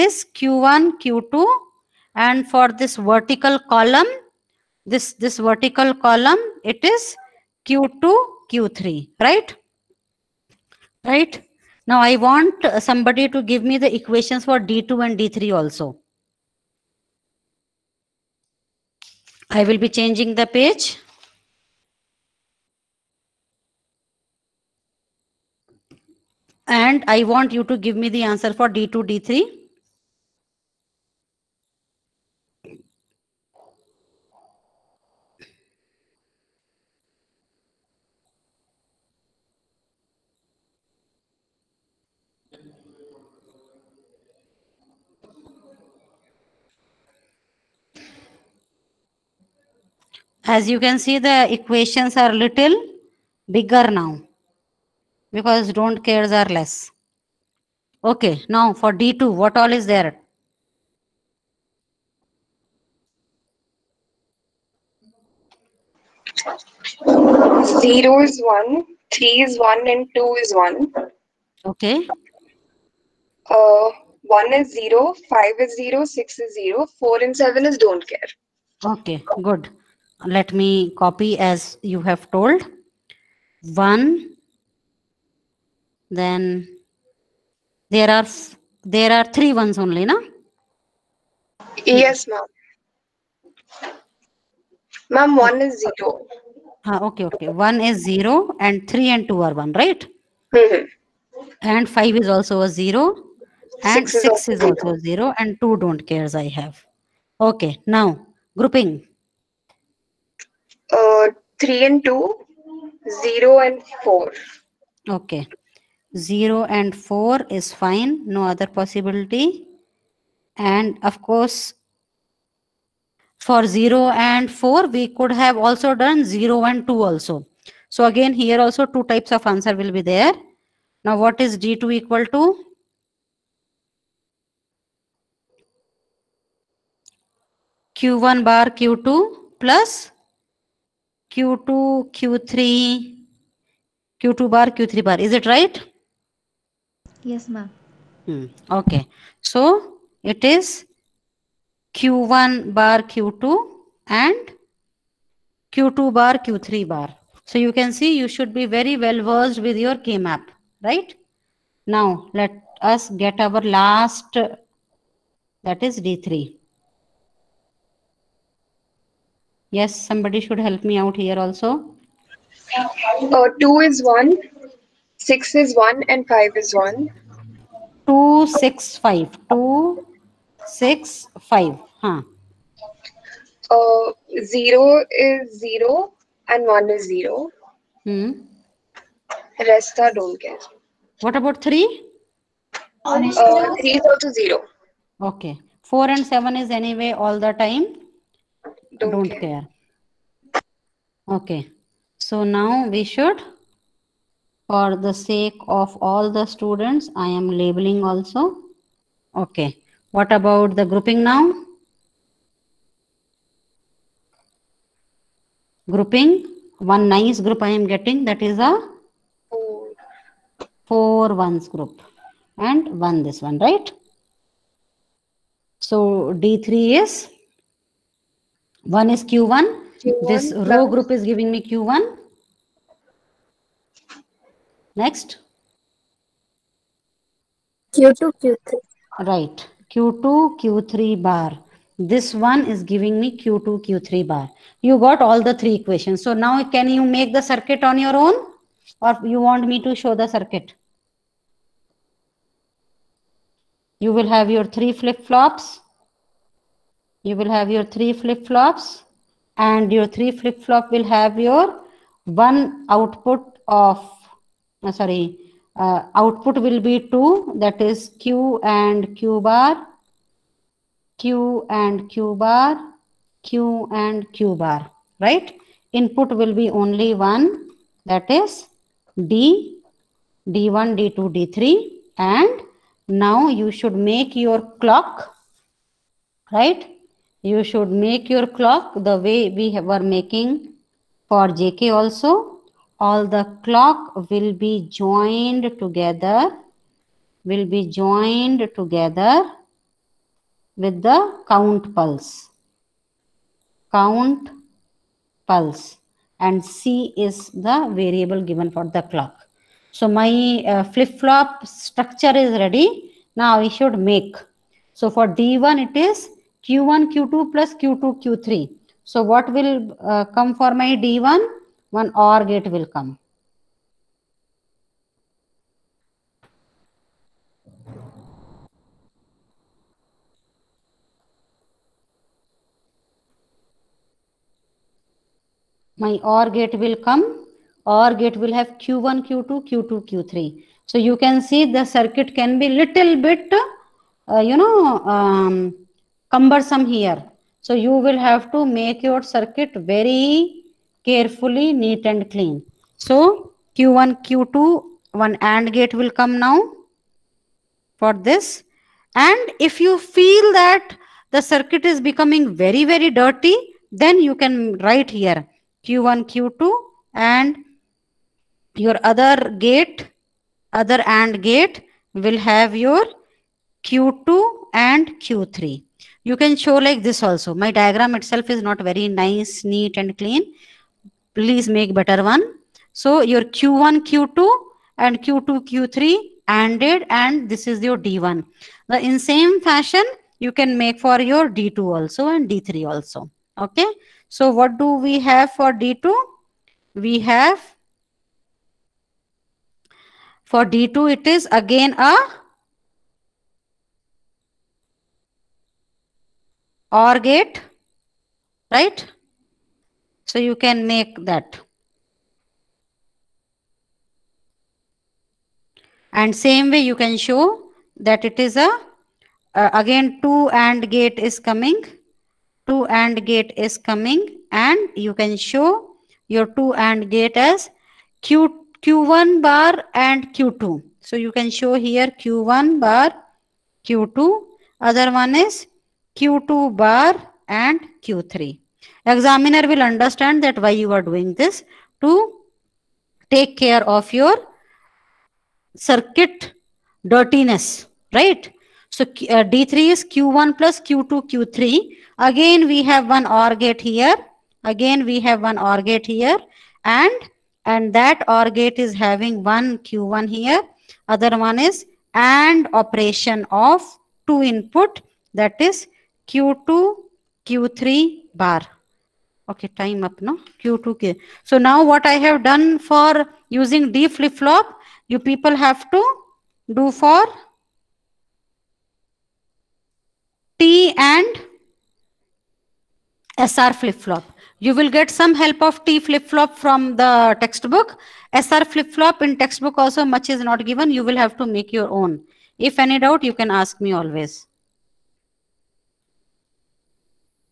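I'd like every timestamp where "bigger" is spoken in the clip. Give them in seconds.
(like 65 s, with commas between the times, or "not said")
53 s.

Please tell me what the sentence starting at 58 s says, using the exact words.
Okay, now for D2, what all is there?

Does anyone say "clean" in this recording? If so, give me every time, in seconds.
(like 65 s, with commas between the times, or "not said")
352 s, 380 s.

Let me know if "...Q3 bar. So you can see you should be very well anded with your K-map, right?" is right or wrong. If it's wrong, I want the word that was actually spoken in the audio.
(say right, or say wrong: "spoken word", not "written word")
wrong: "versed", not "anded".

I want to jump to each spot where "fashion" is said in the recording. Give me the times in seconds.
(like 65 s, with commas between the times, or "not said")
389 s.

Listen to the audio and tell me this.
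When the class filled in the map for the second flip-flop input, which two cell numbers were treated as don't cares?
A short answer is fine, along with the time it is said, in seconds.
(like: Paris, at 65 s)
4 and 7, at 77 s.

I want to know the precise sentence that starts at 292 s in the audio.
All the clock will be joined together, will be joined together with the count pulse.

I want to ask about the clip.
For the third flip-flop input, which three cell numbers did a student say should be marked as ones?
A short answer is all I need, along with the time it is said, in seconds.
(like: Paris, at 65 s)
2, 6 and 5, at 173 s.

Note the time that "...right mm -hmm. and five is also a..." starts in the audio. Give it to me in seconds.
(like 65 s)
99 s.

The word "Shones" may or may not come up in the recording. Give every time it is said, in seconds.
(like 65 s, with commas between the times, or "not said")
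not said.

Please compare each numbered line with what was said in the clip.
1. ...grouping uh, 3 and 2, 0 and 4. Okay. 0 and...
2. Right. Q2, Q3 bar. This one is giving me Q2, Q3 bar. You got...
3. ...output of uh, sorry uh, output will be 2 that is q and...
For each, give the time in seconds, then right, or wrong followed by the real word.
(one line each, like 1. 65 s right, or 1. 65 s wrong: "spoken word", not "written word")
1. 108 s right
2. 239 s right
3. 262 s right.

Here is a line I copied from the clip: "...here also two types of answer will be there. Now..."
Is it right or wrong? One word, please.
right.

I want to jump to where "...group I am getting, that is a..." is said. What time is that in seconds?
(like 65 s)
217 s.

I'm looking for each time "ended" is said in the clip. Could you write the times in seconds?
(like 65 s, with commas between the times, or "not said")
not said.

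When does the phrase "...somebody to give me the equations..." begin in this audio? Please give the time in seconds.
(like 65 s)
12 s.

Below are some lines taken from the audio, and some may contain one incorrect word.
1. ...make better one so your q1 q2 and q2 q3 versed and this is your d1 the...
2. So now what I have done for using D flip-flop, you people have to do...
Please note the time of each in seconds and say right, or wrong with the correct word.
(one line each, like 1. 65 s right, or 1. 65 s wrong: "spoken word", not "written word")
1. 381 s wrong: "anded", not "versed"
2. 471 s right.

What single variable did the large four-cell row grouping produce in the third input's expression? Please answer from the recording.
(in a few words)
Q1.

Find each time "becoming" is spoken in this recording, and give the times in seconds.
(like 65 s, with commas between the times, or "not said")
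362 s.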